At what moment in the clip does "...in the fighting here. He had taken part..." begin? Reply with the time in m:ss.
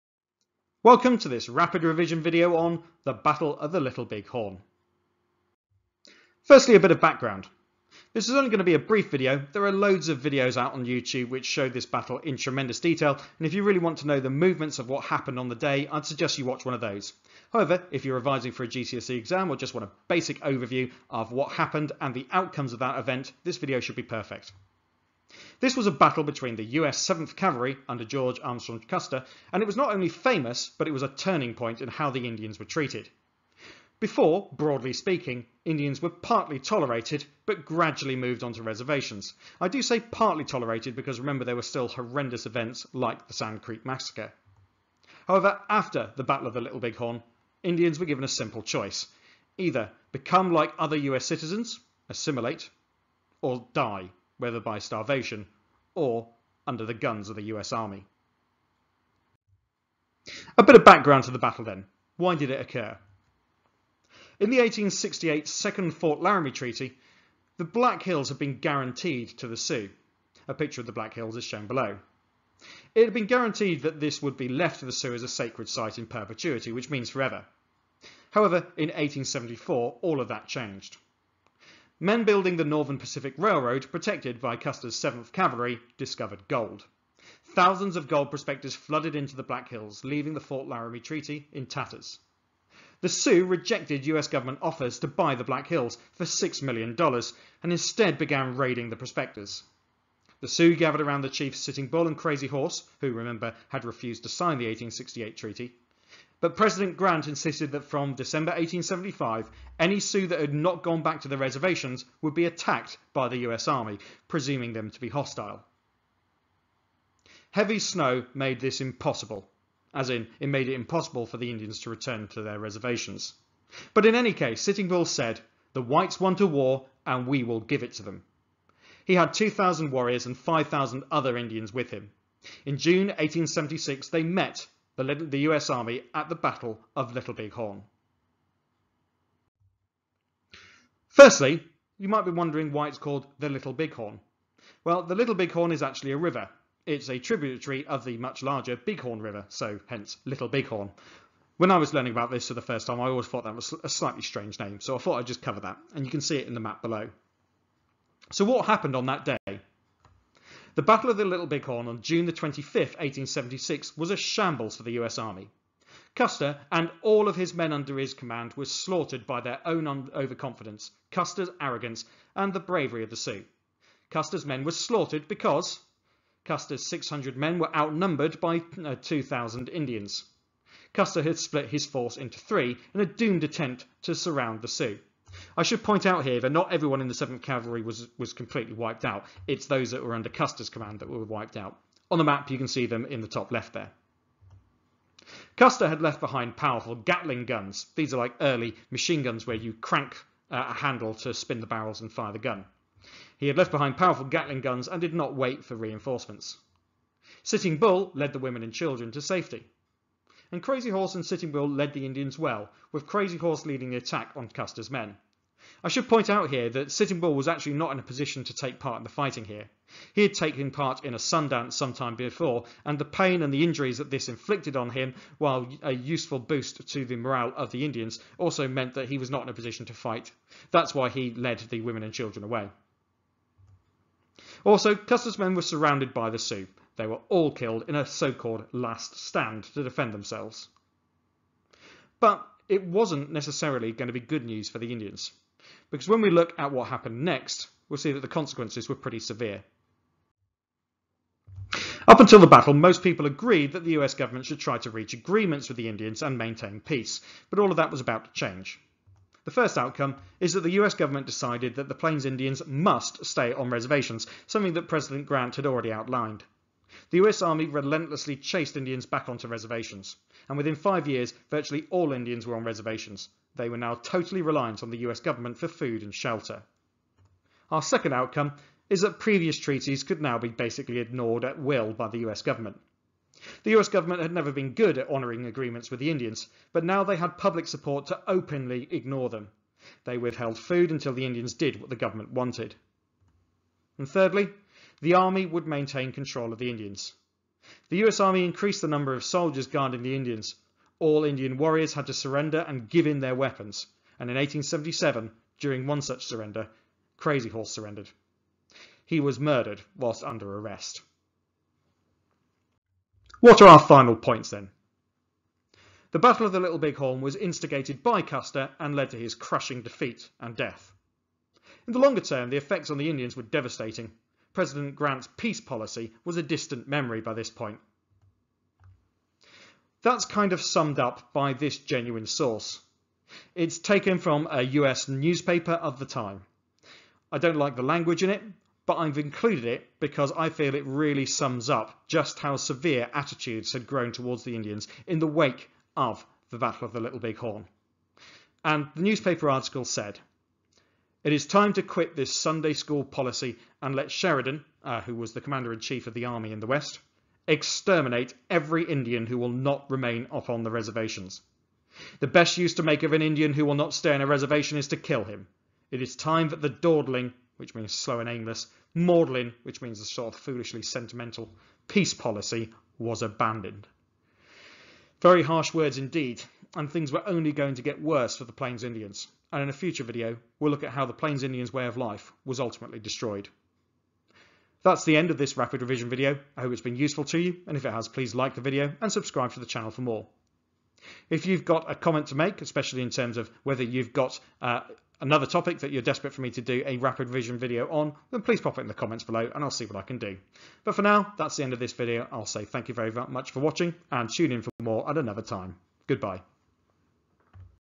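3:38.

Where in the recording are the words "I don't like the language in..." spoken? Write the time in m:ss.
5:37.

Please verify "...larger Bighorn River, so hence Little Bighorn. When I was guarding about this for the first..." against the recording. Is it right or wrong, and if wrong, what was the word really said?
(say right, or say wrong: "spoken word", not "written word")
wrong: "learning", not "guarding".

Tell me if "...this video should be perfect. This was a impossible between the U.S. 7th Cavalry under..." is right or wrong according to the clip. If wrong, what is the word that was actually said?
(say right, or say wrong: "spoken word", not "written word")
wrong: "battle", not "impossible".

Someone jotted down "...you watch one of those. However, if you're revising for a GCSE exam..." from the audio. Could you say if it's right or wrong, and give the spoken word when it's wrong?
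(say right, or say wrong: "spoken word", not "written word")
right.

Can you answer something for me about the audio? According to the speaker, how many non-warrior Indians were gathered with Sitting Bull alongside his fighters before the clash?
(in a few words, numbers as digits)
5,000.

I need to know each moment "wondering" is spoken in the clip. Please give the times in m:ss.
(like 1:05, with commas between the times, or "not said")
2:22.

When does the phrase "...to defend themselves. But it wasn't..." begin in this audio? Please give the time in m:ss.
3:59.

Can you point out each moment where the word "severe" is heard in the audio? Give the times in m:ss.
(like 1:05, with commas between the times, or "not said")
4:09, 5:42.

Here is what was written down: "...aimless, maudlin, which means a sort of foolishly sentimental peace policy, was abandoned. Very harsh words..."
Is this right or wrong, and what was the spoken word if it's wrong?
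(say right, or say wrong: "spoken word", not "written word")
right.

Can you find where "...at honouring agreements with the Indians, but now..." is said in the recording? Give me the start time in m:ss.
4:44.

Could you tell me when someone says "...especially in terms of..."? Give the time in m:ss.
6:32.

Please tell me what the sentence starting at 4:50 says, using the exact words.
They withheld food until the Indians did what the government wanted.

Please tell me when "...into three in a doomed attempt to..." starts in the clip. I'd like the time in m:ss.
3:02.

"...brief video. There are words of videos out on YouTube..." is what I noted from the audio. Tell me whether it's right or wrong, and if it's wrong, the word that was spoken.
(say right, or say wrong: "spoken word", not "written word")
wrong: "loads", not "words".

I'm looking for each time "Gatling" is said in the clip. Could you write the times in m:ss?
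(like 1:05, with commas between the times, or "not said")
3:16, 3:24.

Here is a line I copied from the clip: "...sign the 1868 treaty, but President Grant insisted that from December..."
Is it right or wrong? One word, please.
right.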